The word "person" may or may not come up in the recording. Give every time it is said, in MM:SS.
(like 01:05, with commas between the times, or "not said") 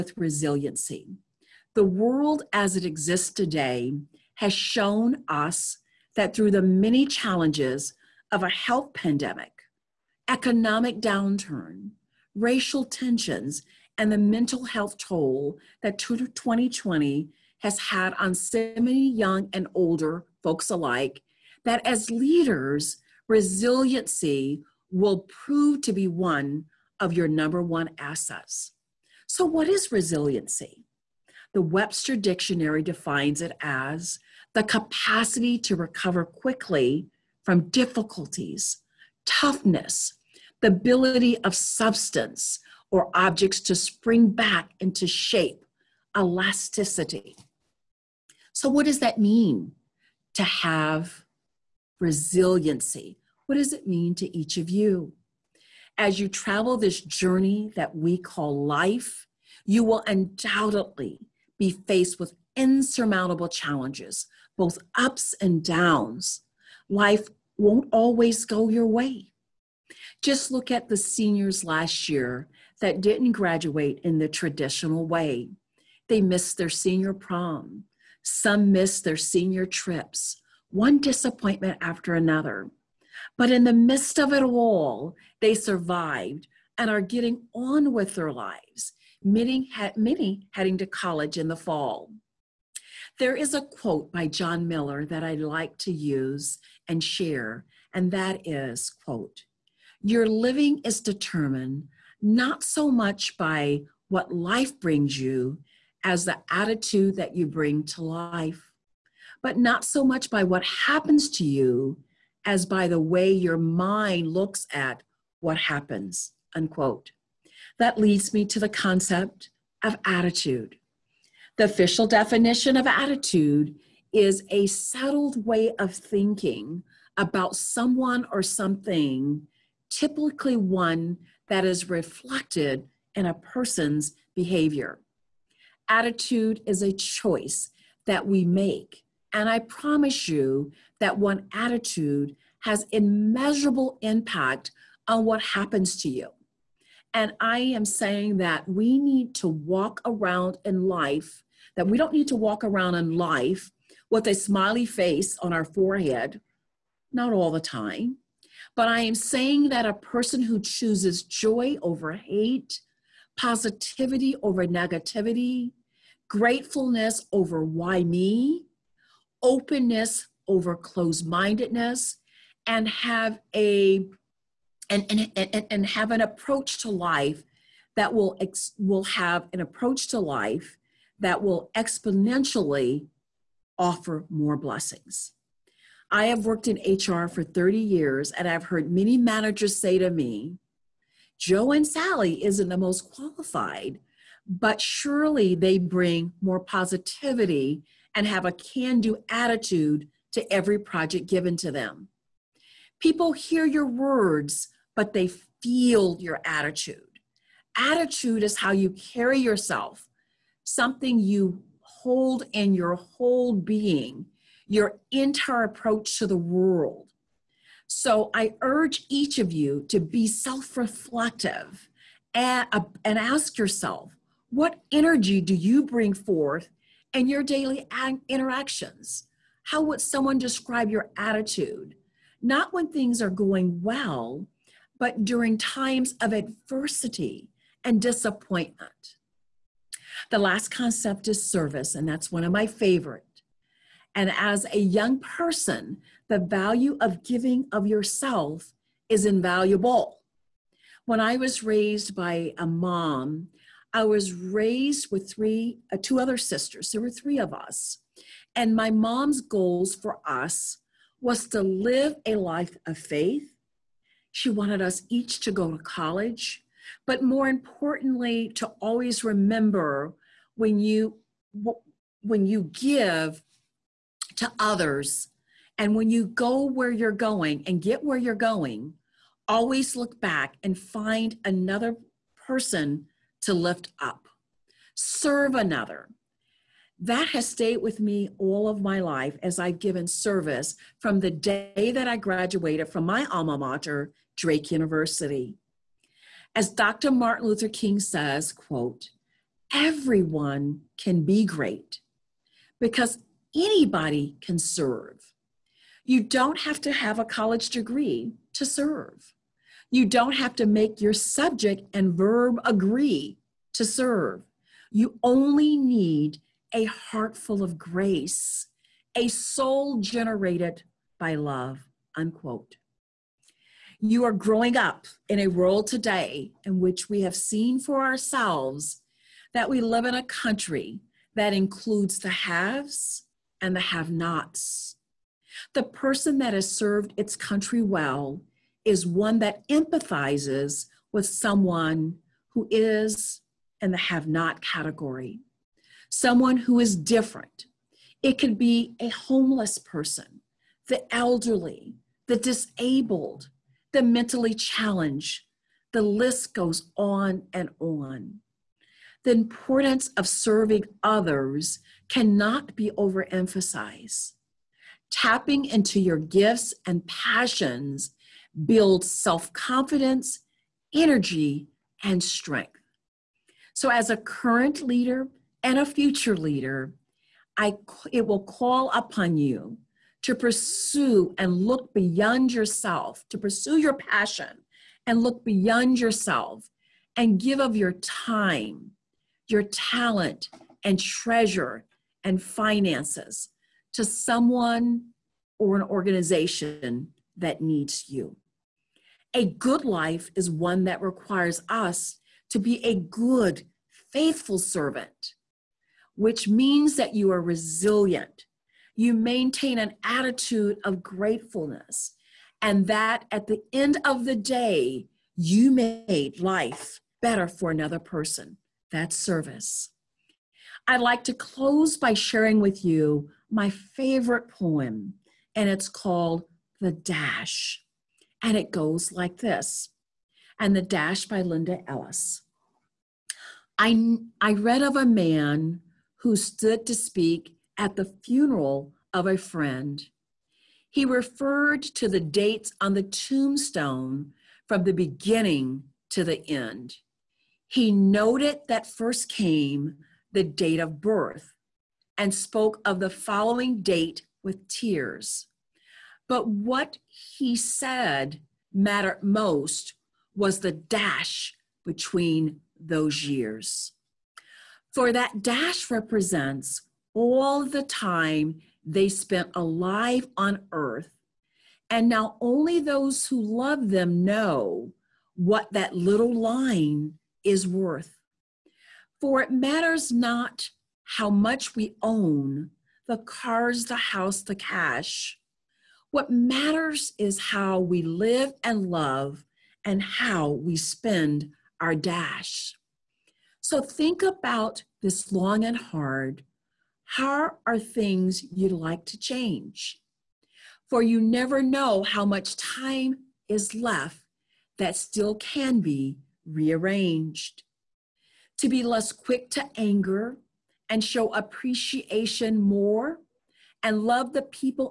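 02:13, 02:39, 04:05, 04:42, 05:35, 05:49, 06:57.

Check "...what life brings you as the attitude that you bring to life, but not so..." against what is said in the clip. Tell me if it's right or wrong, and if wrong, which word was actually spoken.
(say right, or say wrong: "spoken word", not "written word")
right.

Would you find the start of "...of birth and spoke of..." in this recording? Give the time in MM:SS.
07:30.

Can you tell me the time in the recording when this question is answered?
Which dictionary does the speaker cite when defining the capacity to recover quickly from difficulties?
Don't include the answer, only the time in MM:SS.
00:31.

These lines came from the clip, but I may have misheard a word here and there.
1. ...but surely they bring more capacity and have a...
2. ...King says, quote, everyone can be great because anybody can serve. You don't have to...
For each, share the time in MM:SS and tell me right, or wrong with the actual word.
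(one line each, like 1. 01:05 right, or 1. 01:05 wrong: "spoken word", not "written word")
1. 03:14 wrong: "positivity", not "capacity"
2. 04:57 right.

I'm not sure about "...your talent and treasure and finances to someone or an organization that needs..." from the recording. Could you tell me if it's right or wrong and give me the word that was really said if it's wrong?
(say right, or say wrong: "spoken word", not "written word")
right.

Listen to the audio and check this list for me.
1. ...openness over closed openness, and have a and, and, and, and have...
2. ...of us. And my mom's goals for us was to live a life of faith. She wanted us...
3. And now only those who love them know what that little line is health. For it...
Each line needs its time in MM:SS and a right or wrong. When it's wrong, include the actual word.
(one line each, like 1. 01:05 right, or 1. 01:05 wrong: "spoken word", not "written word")
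1. 02:49 wrong: "mindedness", not "openness"
2. 04:17 right
3. 07:51 wrong: "worth", not "health".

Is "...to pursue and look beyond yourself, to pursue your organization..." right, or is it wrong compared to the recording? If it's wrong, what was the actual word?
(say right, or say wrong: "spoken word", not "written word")
wrong: "passion", not "organization".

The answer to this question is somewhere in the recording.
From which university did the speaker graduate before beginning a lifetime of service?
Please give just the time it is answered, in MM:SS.
04:54.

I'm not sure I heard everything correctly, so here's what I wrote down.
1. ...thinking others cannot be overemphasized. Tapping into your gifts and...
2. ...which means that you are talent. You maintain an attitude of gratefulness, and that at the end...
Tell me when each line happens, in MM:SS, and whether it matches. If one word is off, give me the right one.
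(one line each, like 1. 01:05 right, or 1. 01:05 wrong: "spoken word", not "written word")
1. 06:00 wrong: "serving", not "thinking"
2. 06:46 wrong: "resilient", not "talent".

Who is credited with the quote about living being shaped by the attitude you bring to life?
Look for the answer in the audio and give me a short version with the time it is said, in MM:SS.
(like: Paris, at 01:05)
John Miller, at 01:34.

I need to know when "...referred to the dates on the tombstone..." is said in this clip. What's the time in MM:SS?
07:21.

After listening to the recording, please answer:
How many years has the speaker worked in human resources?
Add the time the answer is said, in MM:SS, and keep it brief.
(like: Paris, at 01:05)
30, at 03:07.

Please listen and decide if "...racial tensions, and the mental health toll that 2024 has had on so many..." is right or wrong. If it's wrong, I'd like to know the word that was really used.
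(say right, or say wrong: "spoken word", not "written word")
wrong: "2020", not "2024".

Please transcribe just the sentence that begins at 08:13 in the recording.
So think about this long and hard.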